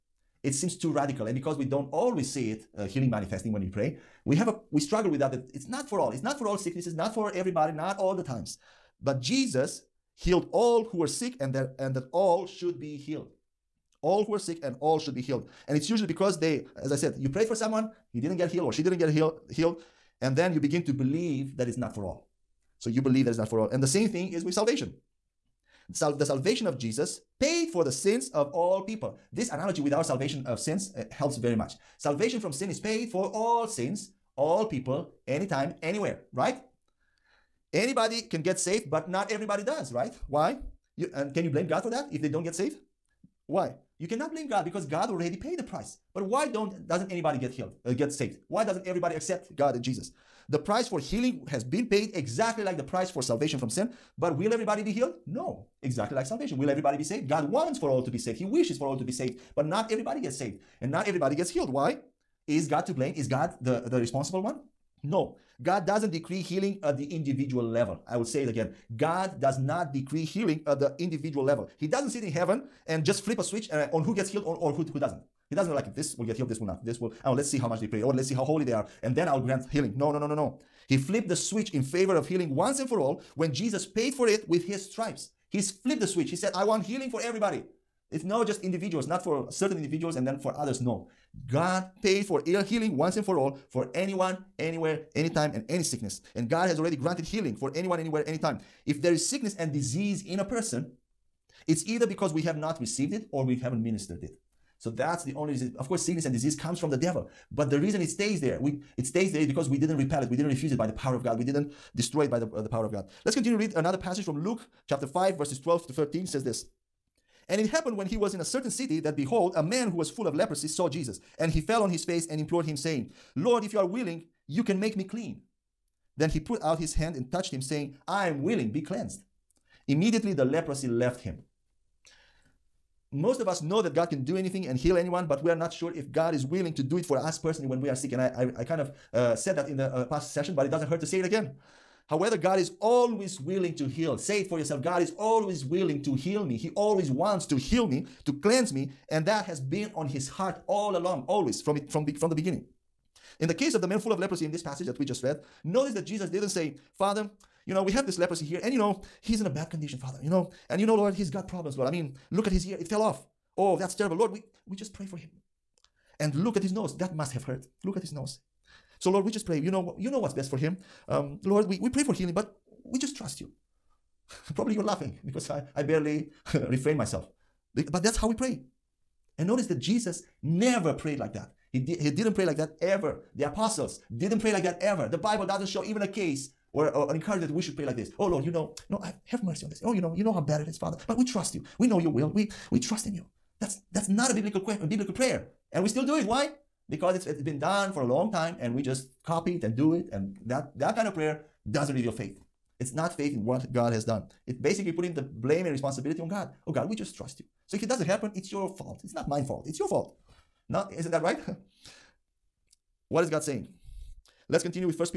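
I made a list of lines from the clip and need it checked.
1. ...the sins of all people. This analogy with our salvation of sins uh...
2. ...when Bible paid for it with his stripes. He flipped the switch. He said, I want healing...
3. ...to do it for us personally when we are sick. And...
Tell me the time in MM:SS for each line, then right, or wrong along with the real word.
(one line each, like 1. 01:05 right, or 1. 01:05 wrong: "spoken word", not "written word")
1. 00:27 right
2. 01:23 wrong: "Jesus", not "Bible"
3. 02:16 right.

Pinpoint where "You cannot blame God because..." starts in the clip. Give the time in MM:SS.
00:43.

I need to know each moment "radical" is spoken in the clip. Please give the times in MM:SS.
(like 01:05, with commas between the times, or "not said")
00:00.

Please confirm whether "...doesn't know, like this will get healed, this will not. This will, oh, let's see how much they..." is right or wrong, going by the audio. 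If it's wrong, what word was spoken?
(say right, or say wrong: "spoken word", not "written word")
right.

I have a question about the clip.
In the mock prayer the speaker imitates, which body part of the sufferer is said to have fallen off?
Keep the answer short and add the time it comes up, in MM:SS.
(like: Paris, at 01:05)
His ear, at 02:42.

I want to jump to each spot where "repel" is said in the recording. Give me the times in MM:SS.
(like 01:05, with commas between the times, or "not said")
01:49.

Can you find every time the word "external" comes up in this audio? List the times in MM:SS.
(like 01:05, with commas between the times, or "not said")
not said.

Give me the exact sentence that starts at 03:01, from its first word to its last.
He, di- he didn't pray like that ever.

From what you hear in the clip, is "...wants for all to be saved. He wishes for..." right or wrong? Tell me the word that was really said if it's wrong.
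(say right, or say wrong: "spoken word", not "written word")
right.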